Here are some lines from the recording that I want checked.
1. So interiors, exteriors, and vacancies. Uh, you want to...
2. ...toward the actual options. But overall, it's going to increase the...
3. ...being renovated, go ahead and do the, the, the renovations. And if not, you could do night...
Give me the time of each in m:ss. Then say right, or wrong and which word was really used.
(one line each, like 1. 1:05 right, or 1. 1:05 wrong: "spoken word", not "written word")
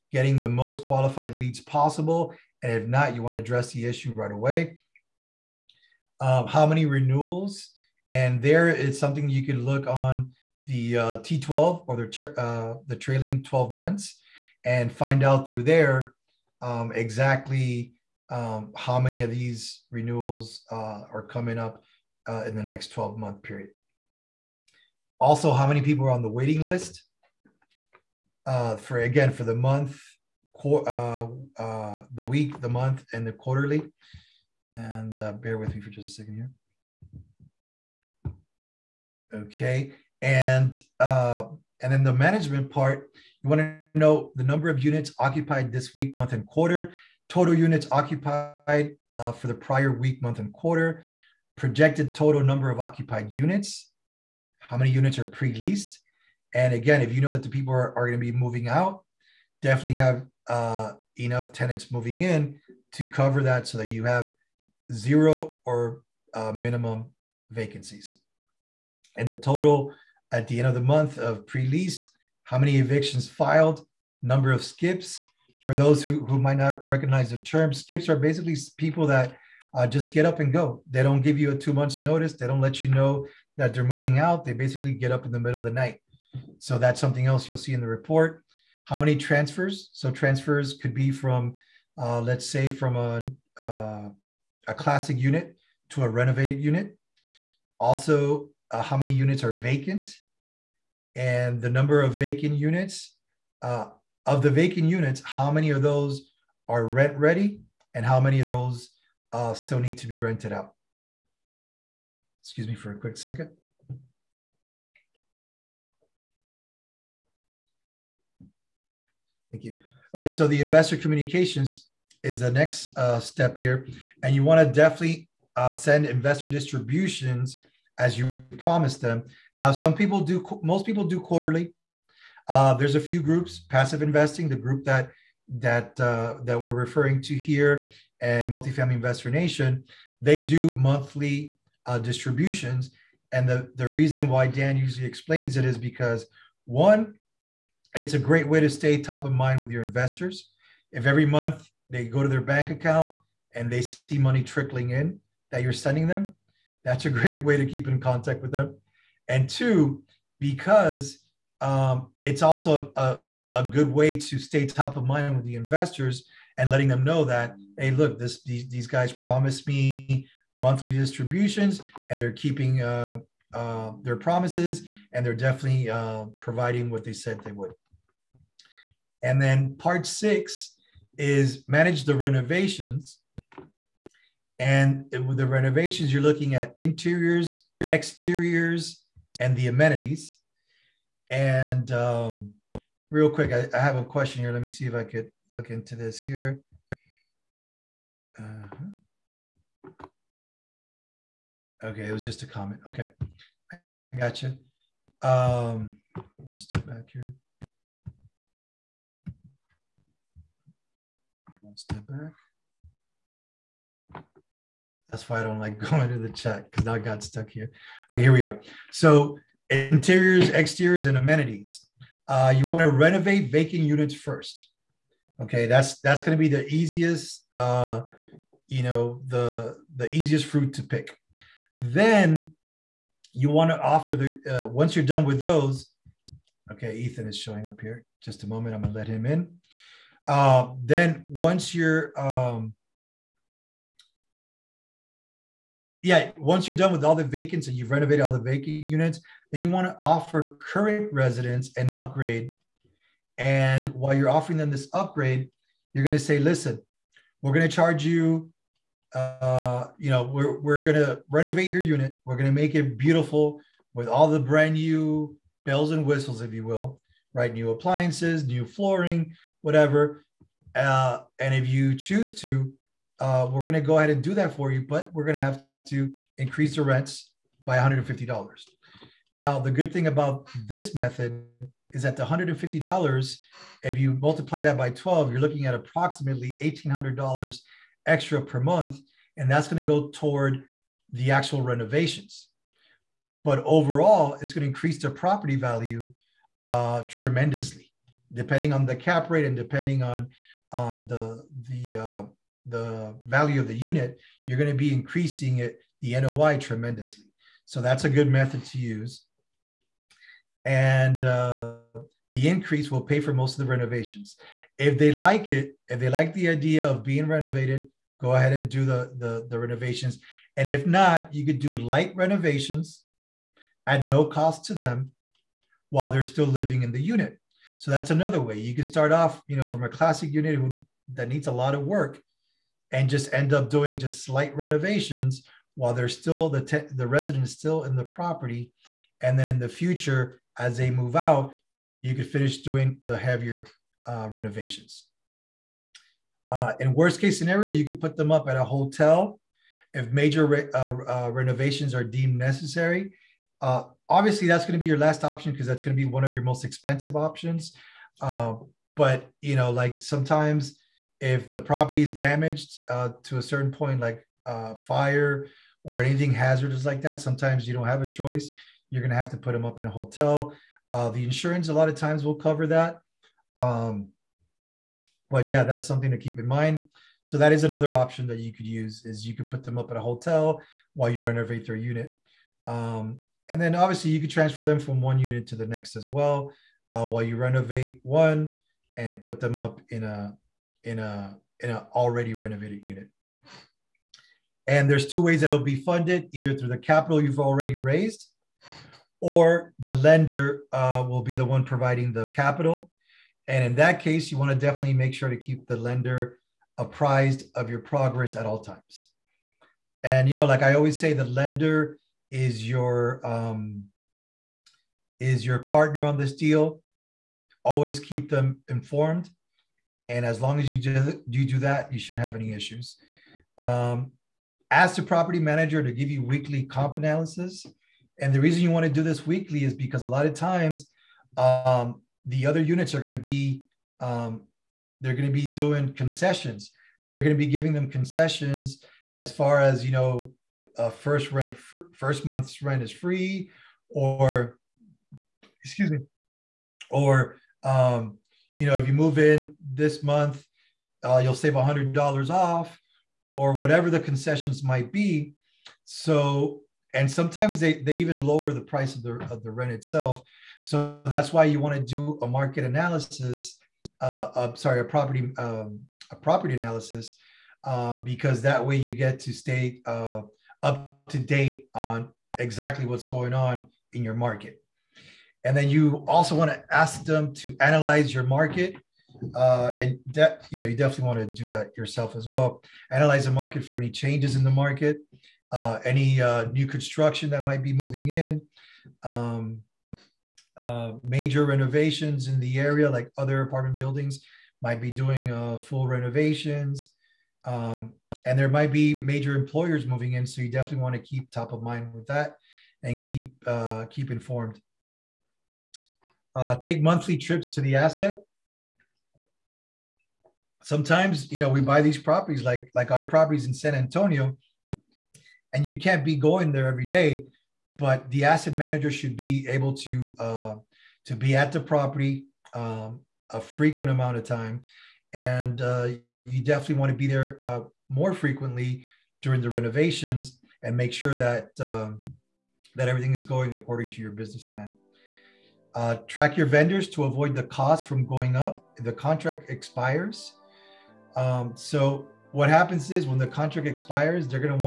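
1. 3:38 wrong: "amenities", not "vacancies"
2. 4:50 wrong: "renovations", not "options"
3. 5:17 wrong: "light", not "night".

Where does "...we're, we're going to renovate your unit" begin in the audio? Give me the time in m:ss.
4:20.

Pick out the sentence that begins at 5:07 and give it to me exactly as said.
So that's a good method to use.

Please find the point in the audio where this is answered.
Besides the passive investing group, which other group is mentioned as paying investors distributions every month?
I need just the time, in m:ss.
2:18.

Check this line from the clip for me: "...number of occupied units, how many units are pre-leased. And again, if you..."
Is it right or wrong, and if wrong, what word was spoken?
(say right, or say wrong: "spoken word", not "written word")
right.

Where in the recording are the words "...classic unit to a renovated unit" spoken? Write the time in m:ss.
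1:34.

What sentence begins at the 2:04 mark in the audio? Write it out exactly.
And you wanna definitely uh, send investor distributions as you promised them.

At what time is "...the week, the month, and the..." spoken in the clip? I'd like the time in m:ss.
0:32.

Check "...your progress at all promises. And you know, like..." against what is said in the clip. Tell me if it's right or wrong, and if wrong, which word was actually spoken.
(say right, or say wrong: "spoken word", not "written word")
wrong: "times", not "promises".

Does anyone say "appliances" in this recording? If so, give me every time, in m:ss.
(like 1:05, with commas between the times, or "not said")
4:27.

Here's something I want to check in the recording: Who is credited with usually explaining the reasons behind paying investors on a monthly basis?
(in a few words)
Dan.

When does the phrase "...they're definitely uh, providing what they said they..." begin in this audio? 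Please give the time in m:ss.
2:55.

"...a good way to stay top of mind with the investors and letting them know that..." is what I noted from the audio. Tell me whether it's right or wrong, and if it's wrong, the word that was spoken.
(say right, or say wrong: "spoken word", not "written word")
right.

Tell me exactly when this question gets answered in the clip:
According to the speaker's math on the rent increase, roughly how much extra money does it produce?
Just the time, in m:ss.
4:46.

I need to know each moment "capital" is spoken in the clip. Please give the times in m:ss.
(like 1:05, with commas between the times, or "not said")
6:36, 6:42.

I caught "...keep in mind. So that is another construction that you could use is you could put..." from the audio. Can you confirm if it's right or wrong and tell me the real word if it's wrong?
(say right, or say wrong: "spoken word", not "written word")
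wrong: "option", not "construction".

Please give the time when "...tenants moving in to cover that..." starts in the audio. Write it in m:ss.
1:01.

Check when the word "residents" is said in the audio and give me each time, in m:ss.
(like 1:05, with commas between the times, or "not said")
4:11, 5:37.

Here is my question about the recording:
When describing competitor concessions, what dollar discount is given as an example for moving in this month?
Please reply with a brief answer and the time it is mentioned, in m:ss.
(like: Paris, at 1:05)
$100, at 7:31.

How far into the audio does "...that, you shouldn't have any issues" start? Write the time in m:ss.
7:01.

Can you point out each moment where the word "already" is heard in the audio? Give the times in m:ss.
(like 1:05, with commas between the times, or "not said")
6:31, 6:37.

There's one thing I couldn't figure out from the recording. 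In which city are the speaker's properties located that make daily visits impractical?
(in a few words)
San Antonio.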